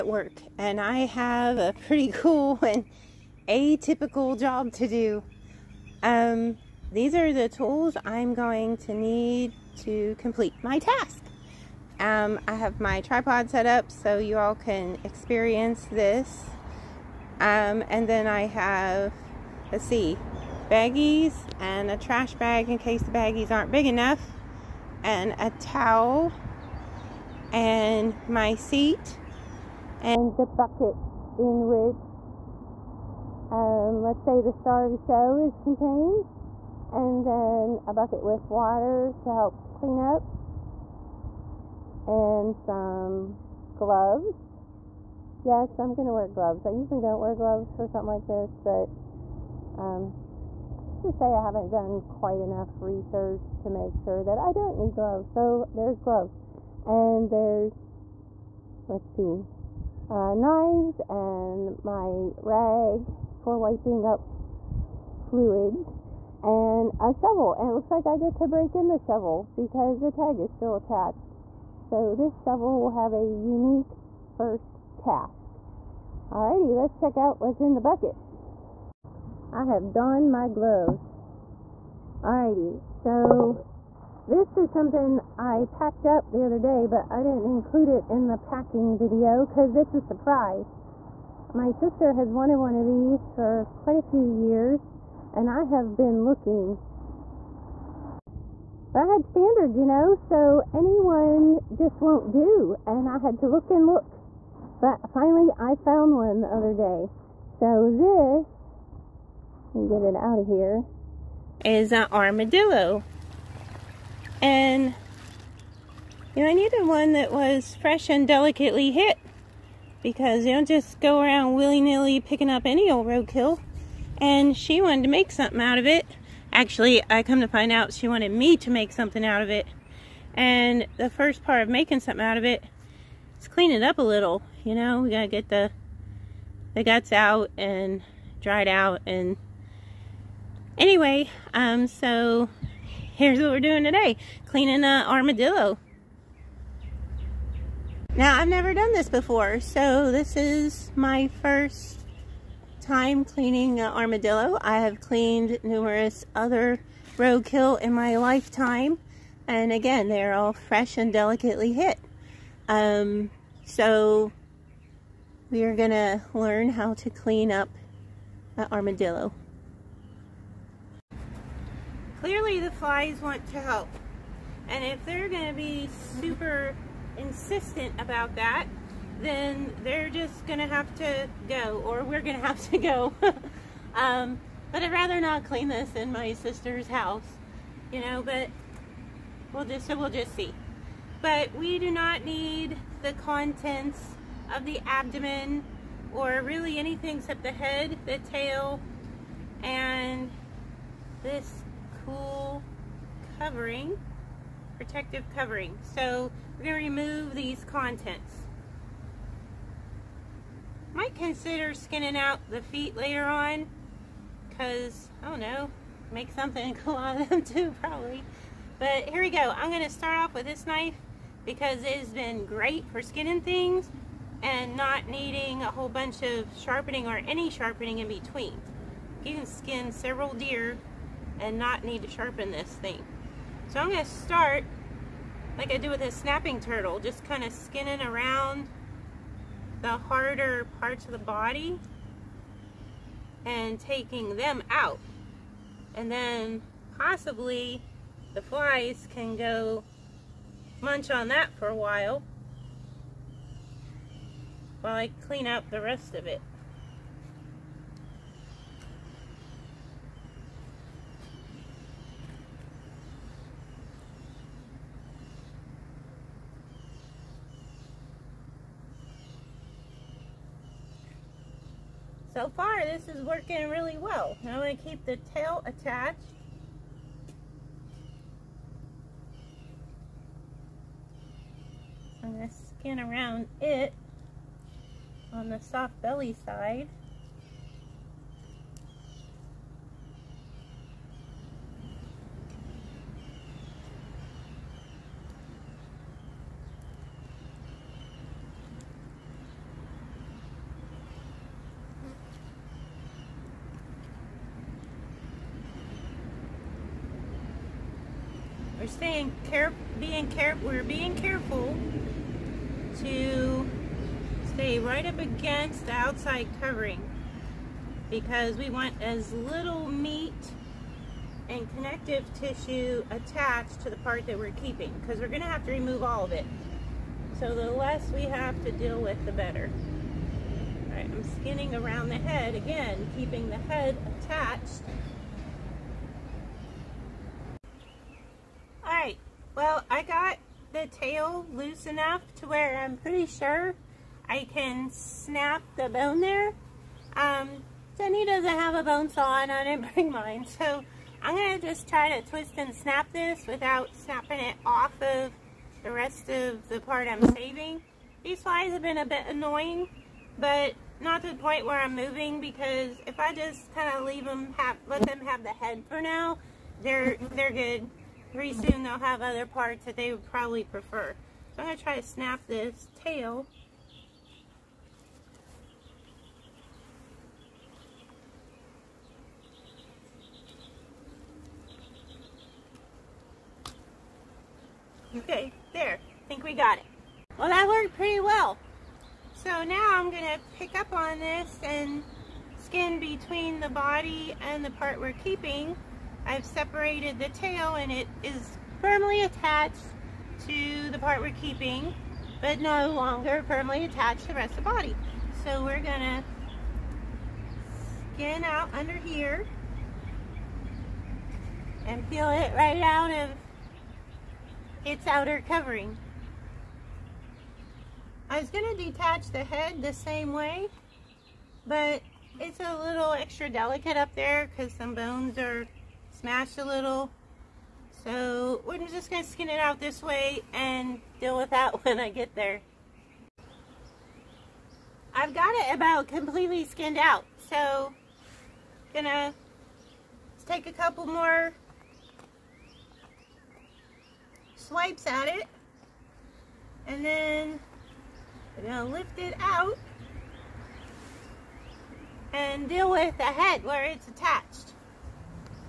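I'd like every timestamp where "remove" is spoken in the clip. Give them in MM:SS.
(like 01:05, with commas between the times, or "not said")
03:26, 05:25.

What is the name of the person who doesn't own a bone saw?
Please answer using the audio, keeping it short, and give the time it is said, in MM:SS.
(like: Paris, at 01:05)
Jenny, at 05:47.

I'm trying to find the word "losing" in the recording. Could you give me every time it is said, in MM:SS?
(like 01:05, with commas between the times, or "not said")
not said.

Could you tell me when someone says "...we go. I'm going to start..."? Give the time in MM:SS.
03:39.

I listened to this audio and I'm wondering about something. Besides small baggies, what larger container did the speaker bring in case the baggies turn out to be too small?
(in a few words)
trash bag.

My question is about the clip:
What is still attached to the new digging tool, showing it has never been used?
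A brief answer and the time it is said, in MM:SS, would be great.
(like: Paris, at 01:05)
the tag, at 01:10.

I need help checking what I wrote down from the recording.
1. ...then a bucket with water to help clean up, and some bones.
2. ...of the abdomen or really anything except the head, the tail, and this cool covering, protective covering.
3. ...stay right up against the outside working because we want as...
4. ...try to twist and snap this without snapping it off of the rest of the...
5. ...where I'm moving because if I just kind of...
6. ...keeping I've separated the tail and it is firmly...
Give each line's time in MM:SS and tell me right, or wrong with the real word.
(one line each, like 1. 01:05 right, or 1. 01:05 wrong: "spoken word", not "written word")
1. 00:37 wrong: "gloves", not "bones"
2. 03:14 right
3. 05:14 wrong: "covering", not "working"
4. 05:51 right
5. 06:01 right
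6. 06:35 right.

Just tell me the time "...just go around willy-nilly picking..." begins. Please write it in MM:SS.
02:00.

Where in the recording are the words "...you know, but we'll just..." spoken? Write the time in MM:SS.
03:07.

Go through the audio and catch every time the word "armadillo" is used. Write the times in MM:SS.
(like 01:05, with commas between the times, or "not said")
01:52, 02:25, 02:33, 02:48.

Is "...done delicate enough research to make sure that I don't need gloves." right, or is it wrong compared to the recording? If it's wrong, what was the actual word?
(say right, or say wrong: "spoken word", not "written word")
wrong: "quite", not "delicate".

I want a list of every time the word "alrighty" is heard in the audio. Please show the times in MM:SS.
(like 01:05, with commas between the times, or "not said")
01:16, 01:22.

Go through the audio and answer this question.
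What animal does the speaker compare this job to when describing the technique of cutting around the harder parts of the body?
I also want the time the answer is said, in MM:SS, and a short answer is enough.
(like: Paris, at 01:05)
snapping turtle, at 03:56.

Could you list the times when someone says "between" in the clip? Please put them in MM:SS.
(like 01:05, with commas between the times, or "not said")
03:48, 06:32.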